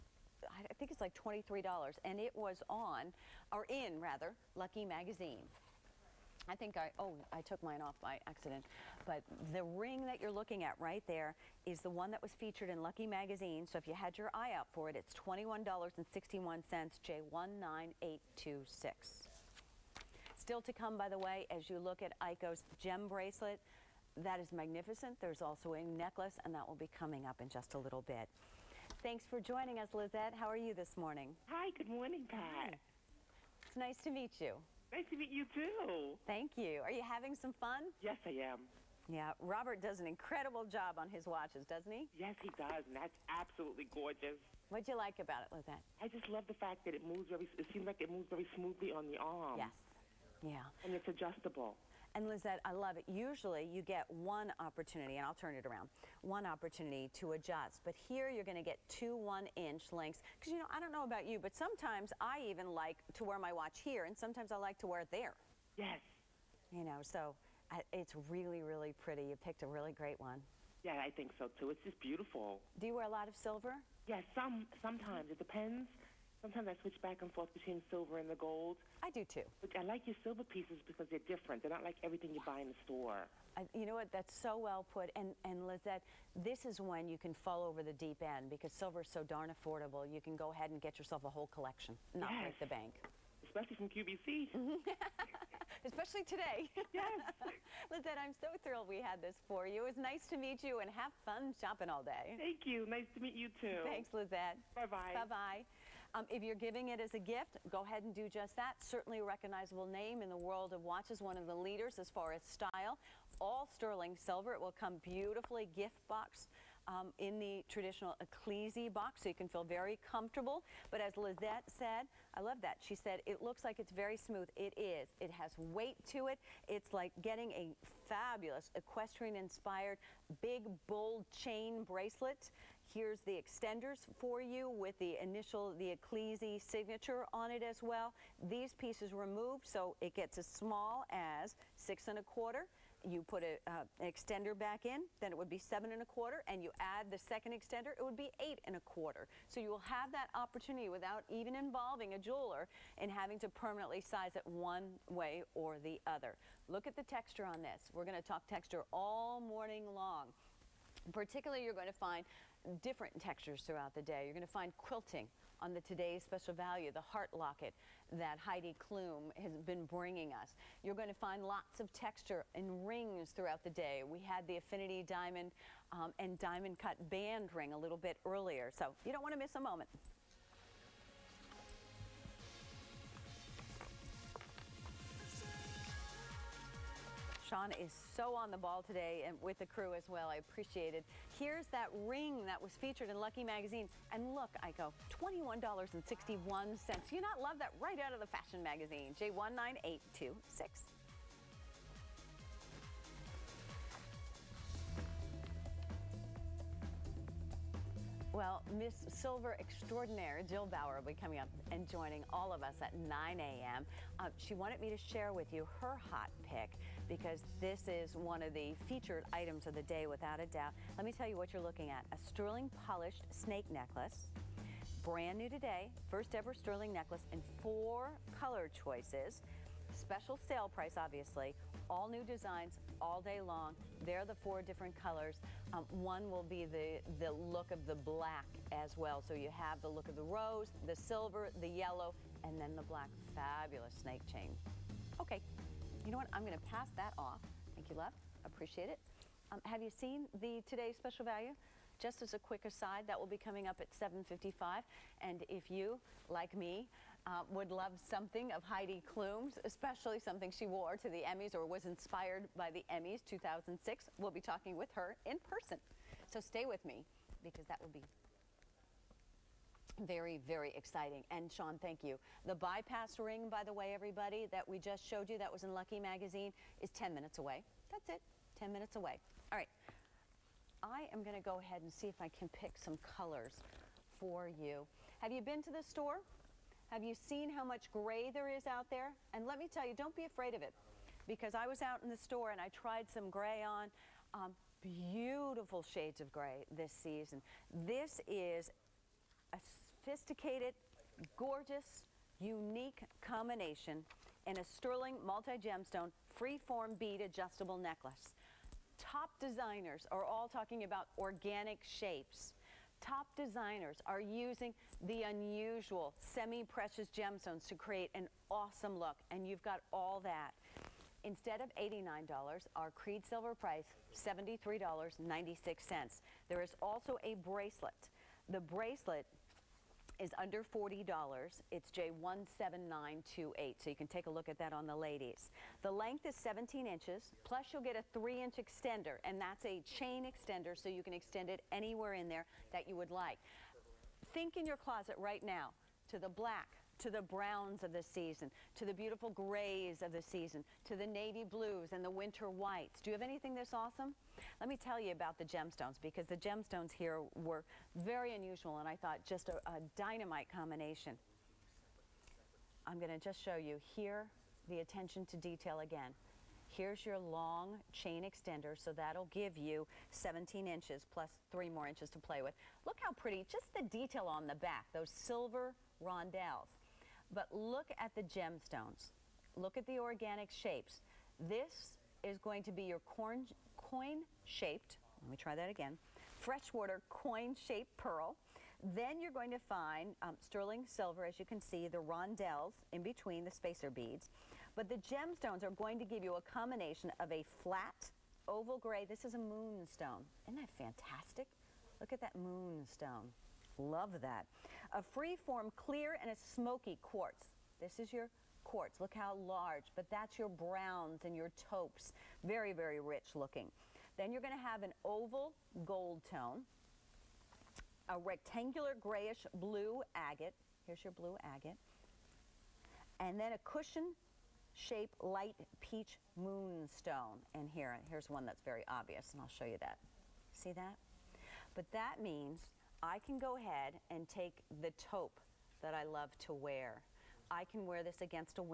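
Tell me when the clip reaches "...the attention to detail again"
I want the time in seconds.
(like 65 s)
364 s.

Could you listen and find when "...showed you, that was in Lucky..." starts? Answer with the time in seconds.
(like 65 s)
275 s.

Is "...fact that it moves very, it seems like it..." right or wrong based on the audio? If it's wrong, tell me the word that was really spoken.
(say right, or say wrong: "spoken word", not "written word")
right.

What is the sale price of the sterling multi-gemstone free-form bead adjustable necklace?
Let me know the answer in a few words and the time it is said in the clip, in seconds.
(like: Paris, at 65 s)
$73.96, at 324 s.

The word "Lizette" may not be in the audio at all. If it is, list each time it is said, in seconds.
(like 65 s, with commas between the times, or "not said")
29 s, 45 s, 52 s, 85 s, 97 s, 104 s, 121 s.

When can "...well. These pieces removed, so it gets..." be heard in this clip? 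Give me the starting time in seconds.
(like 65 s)
137 s.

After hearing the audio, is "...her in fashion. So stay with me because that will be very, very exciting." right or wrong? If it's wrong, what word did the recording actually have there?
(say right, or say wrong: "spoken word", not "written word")
wrong: "person", not "fashion".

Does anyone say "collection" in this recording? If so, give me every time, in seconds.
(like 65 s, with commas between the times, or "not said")
91 s.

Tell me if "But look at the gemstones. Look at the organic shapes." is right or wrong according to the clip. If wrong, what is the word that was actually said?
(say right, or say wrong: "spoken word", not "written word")
right.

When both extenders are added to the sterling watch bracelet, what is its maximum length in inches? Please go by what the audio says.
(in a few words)
8 1/4.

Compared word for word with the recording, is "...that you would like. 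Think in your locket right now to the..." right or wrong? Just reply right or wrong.
wrong.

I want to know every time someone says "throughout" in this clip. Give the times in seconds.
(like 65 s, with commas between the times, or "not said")
163 s, 173 s.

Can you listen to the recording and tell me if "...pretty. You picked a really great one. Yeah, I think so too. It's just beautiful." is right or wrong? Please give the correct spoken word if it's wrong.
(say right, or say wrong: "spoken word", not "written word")
right.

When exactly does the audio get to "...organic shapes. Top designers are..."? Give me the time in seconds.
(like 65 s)
311 s.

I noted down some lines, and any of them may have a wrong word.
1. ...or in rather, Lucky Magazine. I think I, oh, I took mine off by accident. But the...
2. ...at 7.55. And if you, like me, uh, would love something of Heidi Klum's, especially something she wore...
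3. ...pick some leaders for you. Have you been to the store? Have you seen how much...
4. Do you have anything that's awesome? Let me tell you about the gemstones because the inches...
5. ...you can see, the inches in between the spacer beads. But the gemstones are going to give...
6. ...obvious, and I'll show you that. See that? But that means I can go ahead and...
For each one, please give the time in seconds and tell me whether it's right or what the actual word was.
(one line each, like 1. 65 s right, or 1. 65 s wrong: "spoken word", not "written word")
1. 3 s right
2. 253 s right
3. 282 s wrong: "colors", not "leaders"
4. 353 s wrong: "gemstones", not "inches"
5. 391 s wrong: "rondelles", not "inches"
6. 428 s right.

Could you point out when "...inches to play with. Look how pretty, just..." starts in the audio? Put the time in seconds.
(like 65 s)
371 s.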